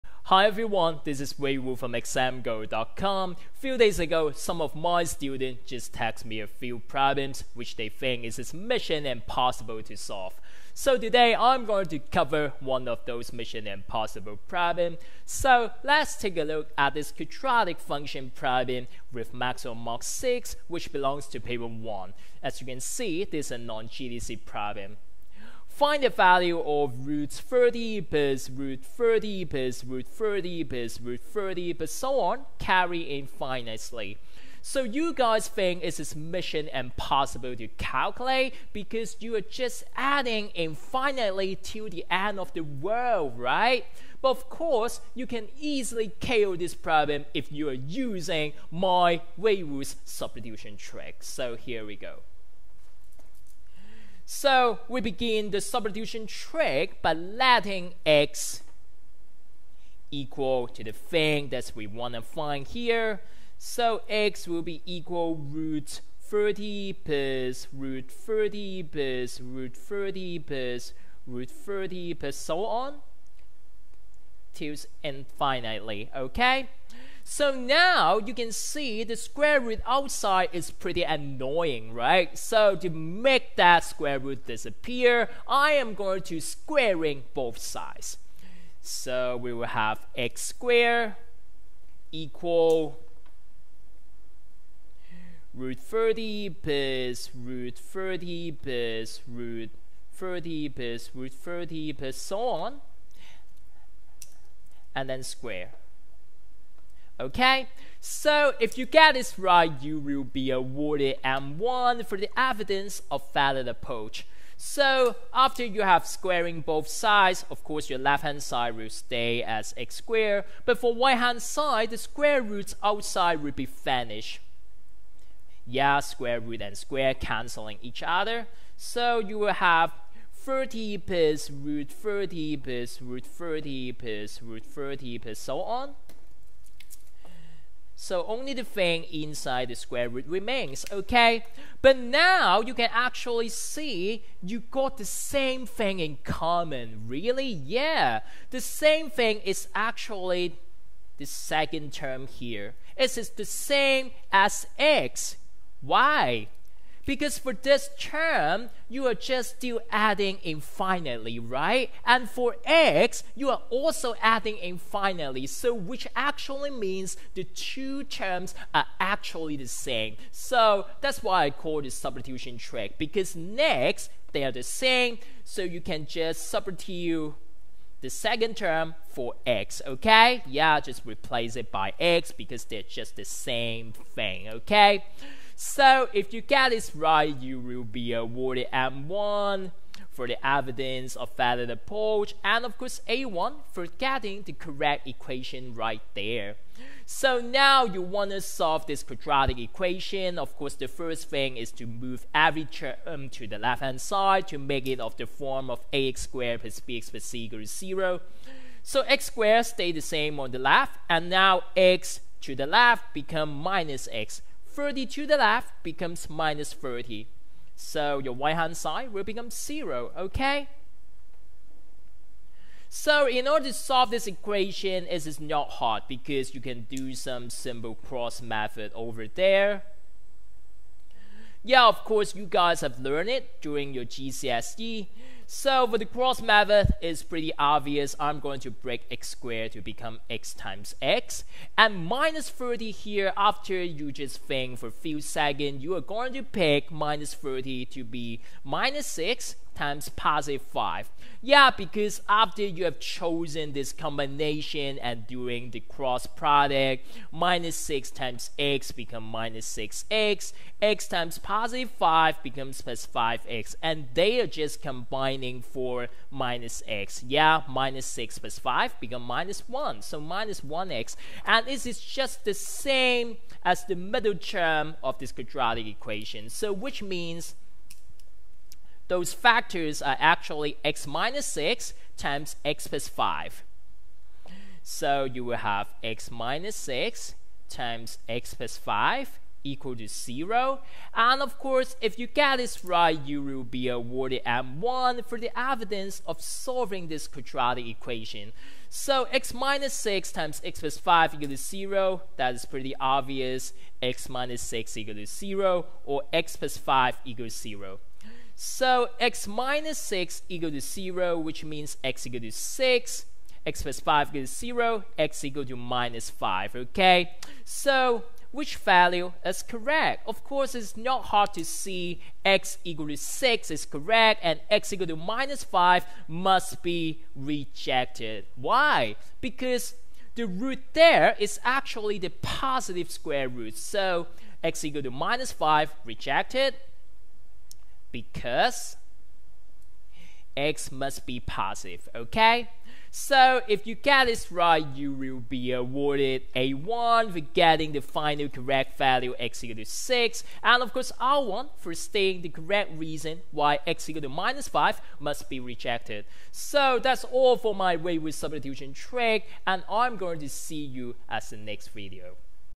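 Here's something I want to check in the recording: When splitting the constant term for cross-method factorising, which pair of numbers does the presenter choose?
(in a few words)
-6 and 5.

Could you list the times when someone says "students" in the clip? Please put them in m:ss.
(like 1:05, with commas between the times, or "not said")
0:05.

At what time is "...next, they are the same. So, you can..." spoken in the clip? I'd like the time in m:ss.
2:53.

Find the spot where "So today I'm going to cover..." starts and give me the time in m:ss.
0:10.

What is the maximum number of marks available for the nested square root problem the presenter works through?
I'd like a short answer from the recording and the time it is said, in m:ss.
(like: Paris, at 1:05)
6, at 0:19.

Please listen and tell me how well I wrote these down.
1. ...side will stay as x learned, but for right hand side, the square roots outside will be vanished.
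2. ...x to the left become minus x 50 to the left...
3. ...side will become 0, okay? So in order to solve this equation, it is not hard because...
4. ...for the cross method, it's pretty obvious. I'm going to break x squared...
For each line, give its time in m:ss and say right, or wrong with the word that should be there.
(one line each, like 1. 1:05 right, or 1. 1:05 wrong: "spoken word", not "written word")
1. 1:58 wrong: "squared", not "learned"
2. 3:31 wrong: "30", not "50"
3. 3:38 right
4. 3:55 right.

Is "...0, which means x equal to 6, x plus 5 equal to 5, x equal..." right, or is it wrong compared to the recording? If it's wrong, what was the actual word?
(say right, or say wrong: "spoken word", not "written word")
wrong: "0", not "5".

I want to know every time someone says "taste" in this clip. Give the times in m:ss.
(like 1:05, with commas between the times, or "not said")
not said.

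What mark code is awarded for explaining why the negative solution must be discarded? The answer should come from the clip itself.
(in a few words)
R1.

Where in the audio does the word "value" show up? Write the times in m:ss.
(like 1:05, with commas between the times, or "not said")
0:26, 5:18, 5:48.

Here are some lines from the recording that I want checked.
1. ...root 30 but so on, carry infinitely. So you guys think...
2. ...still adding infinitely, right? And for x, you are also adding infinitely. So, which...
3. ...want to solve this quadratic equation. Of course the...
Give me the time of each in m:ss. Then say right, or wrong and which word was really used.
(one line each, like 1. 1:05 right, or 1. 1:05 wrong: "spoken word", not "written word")
1. 0:31 right
2. 2:39 right
3. 3:18 right.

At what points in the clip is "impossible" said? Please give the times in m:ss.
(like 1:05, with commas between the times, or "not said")
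0:09, 0:13, 0:36.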